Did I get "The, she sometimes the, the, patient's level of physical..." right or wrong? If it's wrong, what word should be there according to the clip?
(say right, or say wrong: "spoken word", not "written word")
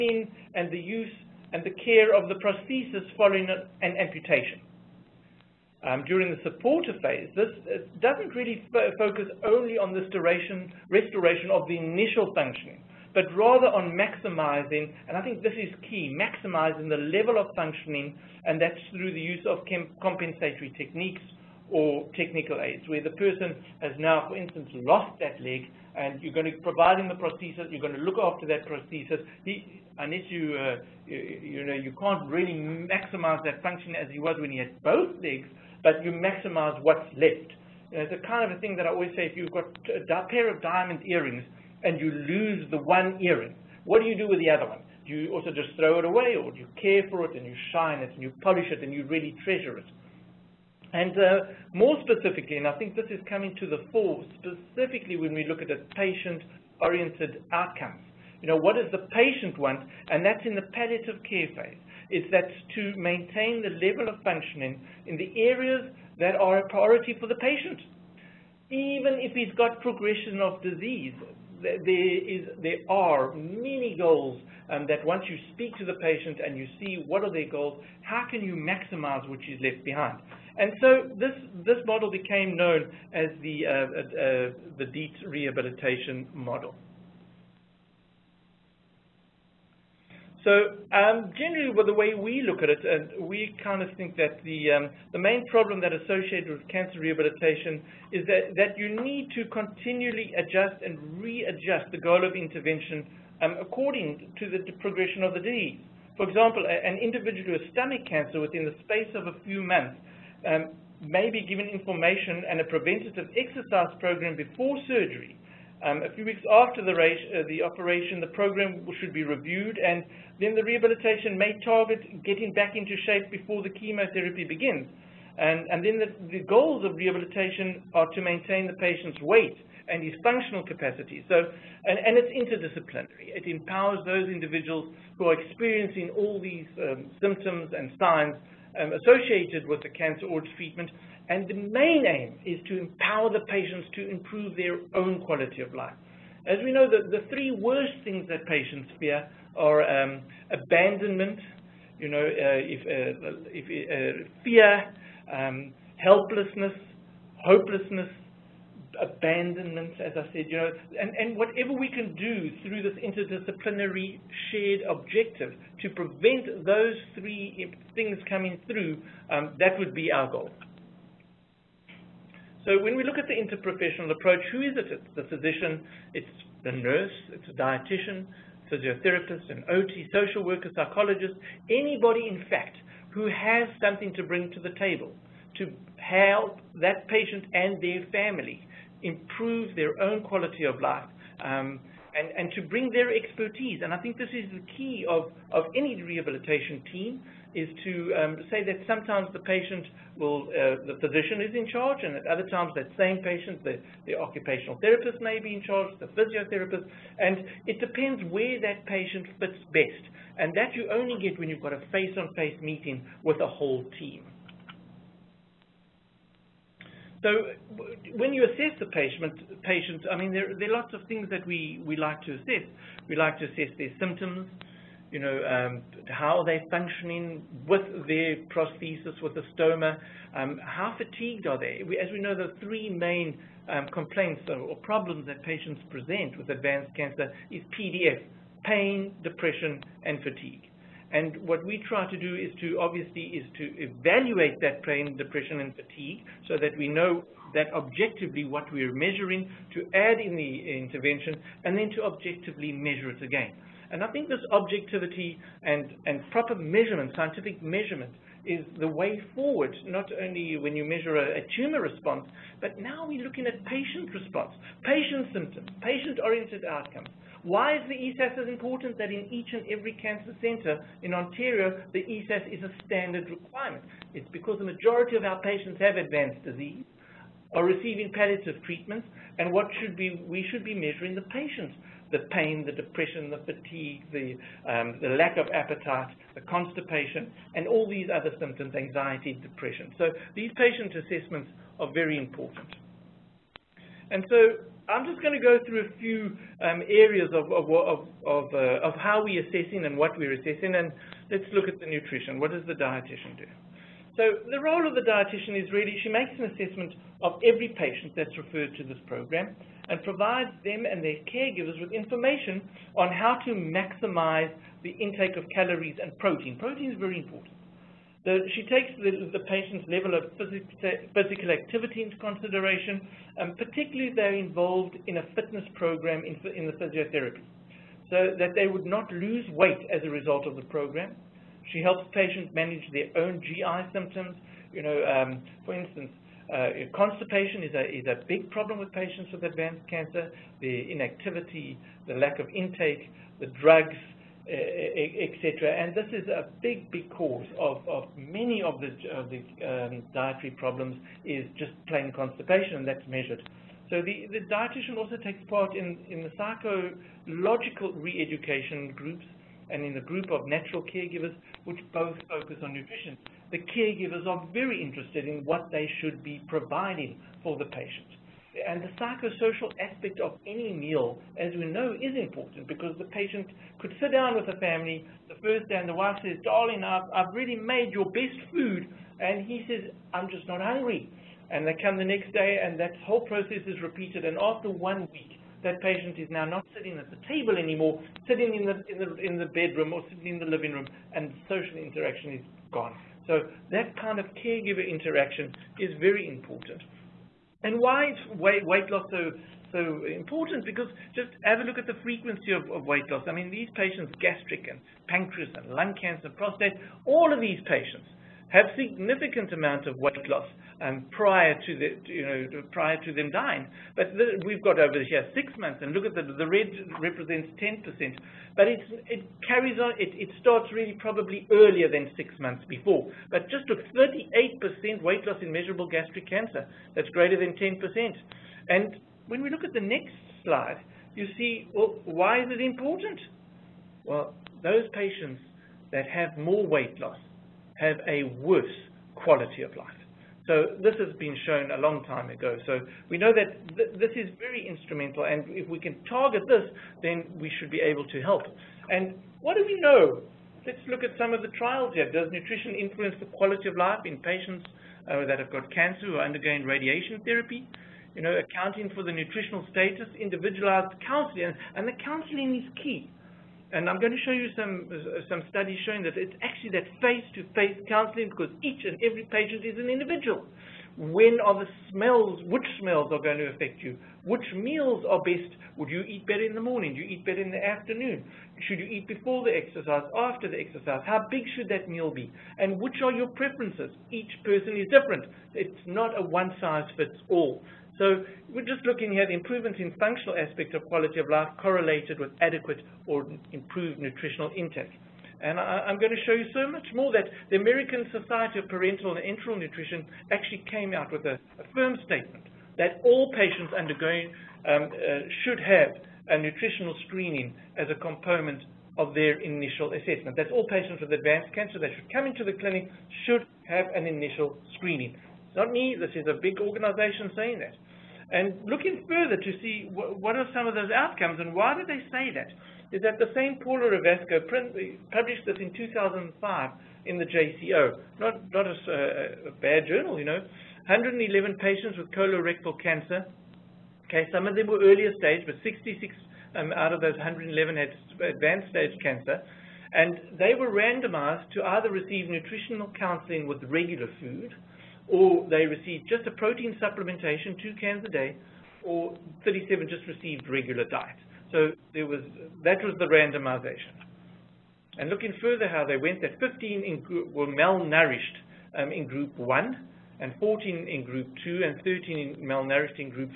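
wrong: "takes", not "sometimes".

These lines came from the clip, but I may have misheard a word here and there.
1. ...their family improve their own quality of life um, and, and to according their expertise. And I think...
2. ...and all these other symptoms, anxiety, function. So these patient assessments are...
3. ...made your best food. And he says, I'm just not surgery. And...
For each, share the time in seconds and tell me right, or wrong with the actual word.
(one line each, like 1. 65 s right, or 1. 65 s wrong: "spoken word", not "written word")
1. 187 s wrong: "bring", not "according"
2. 287 s wrong: "depression", not "function"
3. 377 s wrong: "hungry", not "surgery".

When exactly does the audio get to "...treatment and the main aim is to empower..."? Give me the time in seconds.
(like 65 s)
140 s.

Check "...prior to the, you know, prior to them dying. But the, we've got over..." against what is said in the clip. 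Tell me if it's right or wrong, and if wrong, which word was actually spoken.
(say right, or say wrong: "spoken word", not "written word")
right.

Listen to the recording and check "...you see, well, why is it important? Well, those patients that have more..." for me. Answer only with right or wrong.
right.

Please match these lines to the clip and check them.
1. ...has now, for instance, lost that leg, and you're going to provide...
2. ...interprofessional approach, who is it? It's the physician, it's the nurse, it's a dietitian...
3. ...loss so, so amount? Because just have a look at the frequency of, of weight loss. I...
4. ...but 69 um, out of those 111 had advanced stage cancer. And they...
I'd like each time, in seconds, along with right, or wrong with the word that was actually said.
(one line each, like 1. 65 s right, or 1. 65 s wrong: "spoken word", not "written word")
1. 23 s right
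2. 173 s right
3. 398 s wrong: "important", not "amount"
4. 535 s wrong: "66", not "69".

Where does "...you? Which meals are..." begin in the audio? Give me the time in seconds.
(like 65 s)
473 s.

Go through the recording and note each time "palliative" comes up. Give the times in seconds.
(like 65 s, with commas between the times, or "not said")
60 s, 278 s.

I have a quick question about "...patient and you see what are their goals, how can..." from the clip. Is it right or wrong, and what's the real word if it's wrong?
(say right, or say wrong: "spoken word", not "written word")
right.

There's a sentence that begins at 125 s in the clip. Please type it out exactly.
And, and then the, the, goals of rehabilitation are to maintain the patient's weight and his functional capacity.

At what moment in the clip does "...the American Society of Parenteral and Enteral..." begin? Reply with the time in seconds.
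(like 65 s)
497 s.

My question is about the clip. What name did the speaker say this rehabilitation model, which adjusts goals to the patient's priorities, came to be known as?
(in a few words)
Dietz rehabilitation model.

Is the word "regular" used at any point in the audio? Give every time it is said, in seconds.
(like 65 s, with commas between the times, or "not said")
543 s, 550 s.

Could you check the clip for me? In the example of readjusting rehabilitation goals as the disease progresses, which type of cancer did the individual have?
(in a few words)
stomach cancer.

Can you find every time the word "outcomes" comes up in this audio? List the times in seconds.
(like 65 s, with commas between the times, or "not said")
57 s, 266 s, 520 s.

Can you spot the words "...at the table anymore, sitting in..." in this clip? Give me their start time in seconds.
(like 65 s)
386 s.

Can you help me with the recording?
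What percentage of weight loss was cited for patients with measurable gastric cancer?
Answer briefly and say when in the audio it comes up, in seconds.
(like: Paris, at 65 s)
38%, at 423 s.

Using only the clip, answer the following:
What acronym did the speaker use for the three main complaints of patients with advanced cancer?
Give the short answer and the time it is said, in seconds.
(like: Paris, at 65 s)
PDF, at 237 s.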